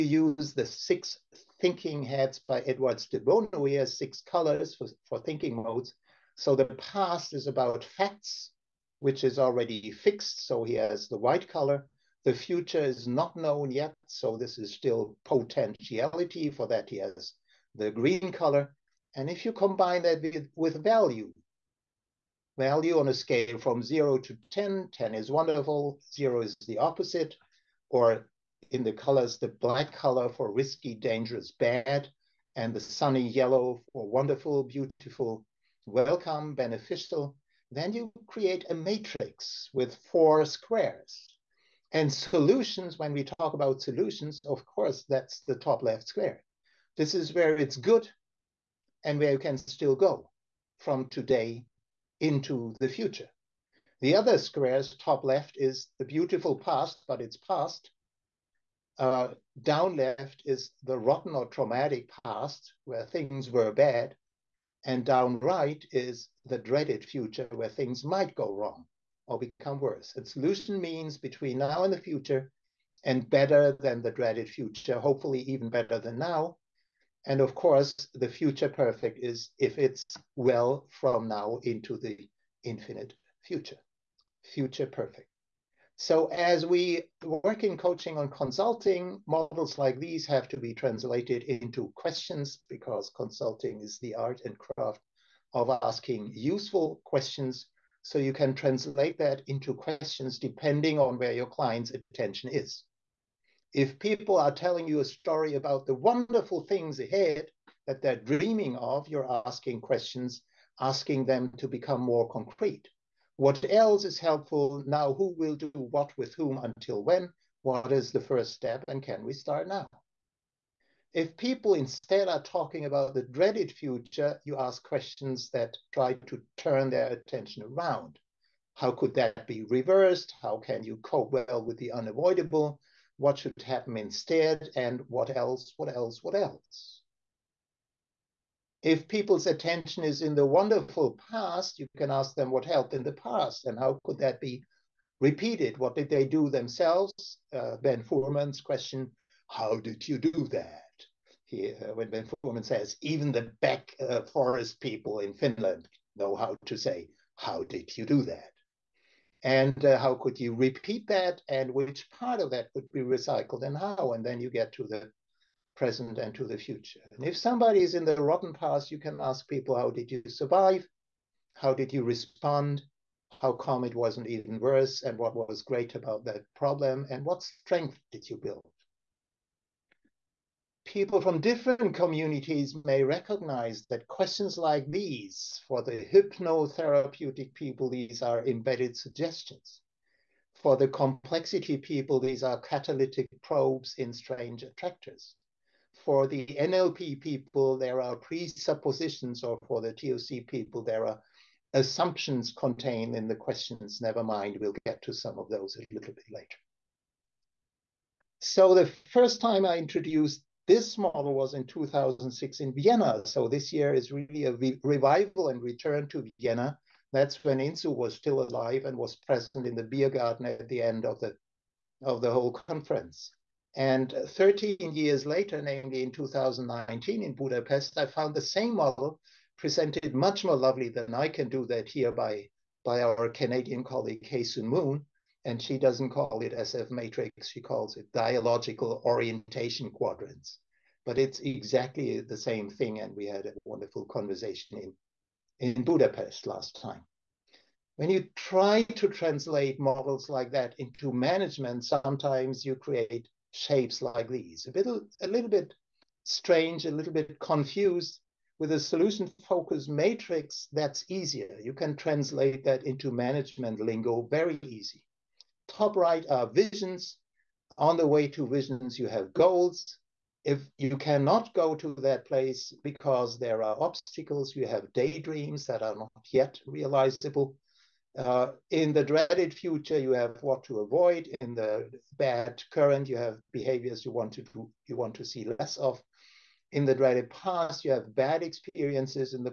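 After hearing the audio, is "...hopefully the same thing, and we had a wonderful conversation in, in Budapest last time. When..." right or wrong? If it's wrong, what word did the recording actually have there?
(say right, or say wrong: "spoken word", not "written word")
wrong: "exactly", not "hopefully".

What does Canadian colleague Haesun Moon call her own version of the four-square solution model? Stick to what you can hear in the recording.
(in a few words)
Dialogical orientation quadrants.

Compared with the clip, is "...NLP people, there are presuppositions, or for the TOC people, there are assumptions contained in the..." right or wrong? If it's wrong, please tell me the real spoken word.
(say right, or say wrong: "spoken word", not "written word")
right.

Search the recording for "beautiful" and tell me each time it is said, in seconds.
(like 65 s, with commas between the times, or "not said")
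34 s, 56 s.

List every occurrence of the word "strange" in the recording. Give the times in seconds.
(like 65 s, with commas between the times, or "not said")
194 s, 256 s.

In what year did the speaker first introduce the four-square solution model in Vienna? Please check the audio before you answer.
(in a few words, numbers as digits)
2006.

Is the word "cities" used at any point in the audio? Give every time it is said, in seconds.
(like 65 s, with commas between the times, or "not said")
not said.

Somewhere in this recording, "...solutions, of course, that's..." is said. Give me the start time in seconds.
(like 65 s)
43 s.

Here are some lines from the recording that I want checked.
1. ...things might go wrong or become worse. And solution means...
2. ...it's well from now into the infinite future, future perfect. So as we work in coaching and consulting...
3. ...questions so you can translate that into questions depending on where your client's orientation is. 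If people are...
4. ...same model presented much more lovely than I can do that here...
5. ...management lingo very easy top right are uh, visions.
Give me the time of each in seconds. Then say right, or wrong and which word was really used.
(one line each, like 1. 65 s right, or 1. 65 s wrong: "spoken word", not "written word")
1. 67 s right
2. 79 s right
3. 97 s wrong: "attention", not "orientation"
4. 228 s right
5. 263 s right.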